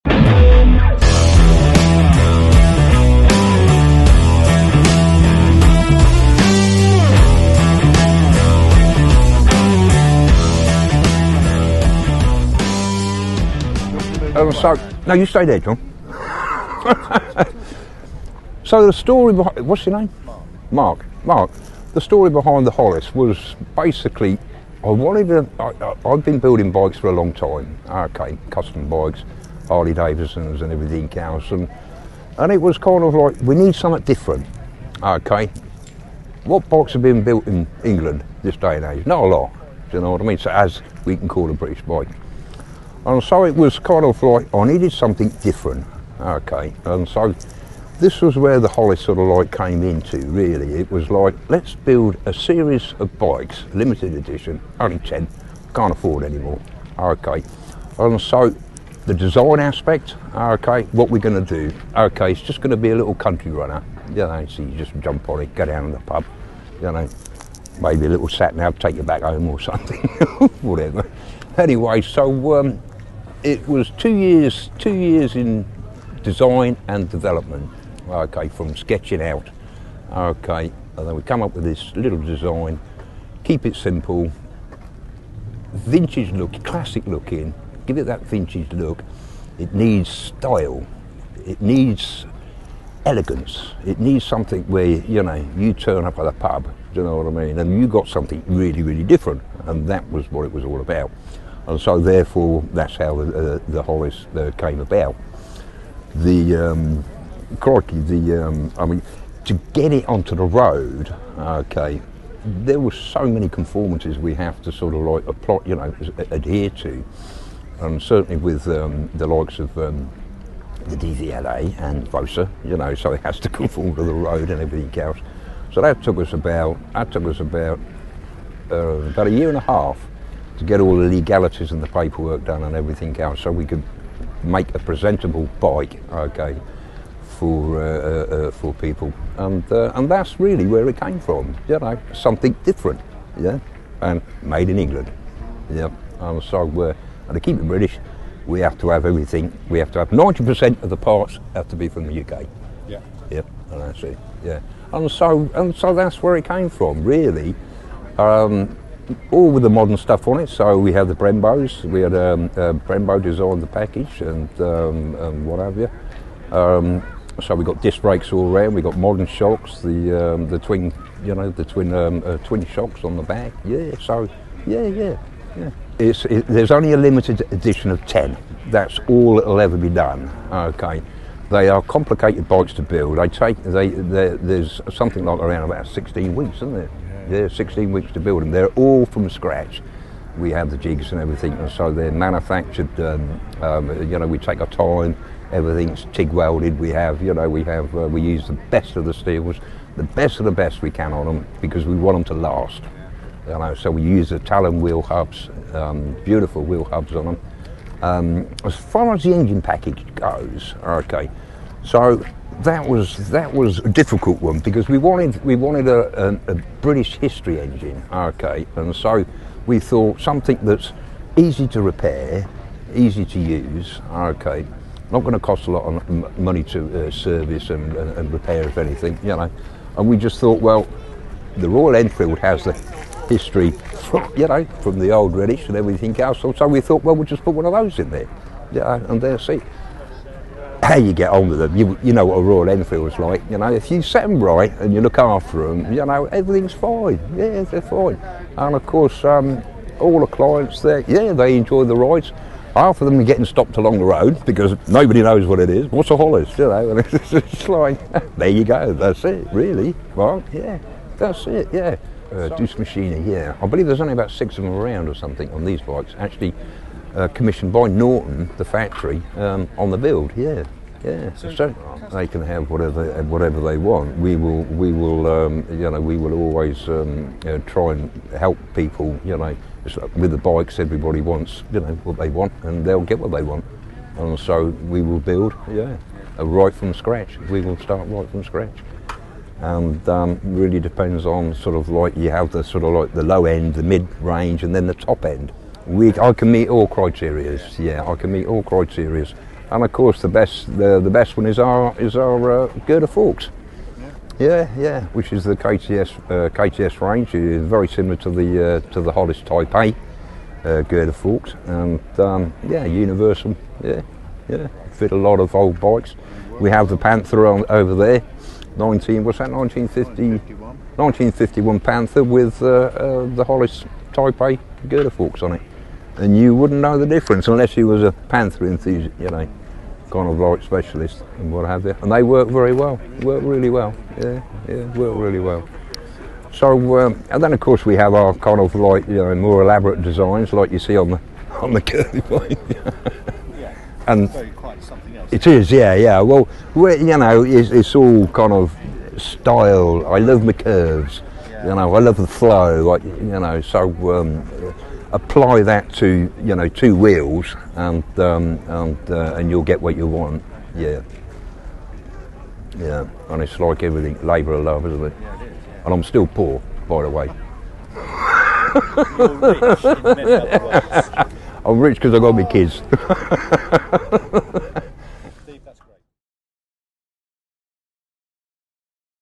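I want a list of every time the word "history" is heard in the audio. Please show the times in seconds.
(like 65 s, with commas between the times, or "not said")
217 s, 233 s.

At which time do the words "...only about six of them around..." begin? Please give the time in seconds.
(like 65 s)
264 s.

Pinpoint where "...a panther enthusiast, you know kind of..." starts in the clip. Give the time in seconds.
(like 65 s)
328 s.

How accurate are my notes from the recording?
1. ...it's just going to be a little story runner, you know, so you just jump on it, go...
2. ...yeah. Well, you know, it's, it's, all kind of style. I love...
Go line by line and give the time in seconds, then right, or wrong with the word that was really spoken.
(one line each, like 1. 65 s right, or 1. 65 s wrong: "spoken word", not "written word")
1. 62 s wrong: "country", not "story"
2. 345 s right.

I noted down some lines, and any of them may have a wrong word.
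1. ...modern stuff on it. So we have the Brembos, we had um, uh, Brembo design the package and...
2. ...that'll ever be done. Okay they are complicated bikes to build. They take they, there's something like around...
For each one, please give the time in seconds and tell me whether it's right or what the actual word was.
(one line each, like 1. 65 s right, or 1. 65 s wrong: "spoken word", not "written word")
1. 159 s right
2. 179 s right.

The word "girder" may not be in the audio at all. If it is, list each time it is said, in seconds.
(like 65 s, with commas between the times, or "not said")
302 s, 310 s, 324 s.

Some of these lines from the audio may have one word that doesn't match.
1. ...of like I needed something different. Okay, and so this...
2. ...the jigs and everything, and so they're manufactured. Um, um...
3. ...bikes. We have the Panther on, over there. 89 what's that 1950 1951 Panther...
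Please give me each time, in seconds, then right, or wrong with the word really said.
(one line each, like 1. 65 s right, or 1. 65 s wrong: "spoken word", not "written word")
1. 44 s right
2. 190 s right
3. 315 s wrong: "19", not "89".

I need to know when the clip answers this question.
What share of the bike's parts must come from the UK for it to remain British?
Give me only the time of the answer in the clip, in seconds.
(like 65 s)
150 s.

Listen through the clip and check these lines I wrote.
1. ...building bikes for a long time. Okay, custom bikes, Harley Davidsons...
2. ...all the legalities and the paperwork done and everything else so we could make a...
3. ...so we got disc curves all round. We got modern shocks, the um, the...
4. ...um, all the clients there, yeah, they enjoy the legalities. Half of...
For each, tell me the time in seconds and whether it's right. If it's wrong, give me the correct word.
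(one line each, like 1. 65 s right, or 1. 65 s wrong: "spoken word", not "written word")
1. 26 s right
2. 130 s right
3. 167 s wrong: "brakes", not "curves"
4. 249 s wrong: "rides", not "legalities".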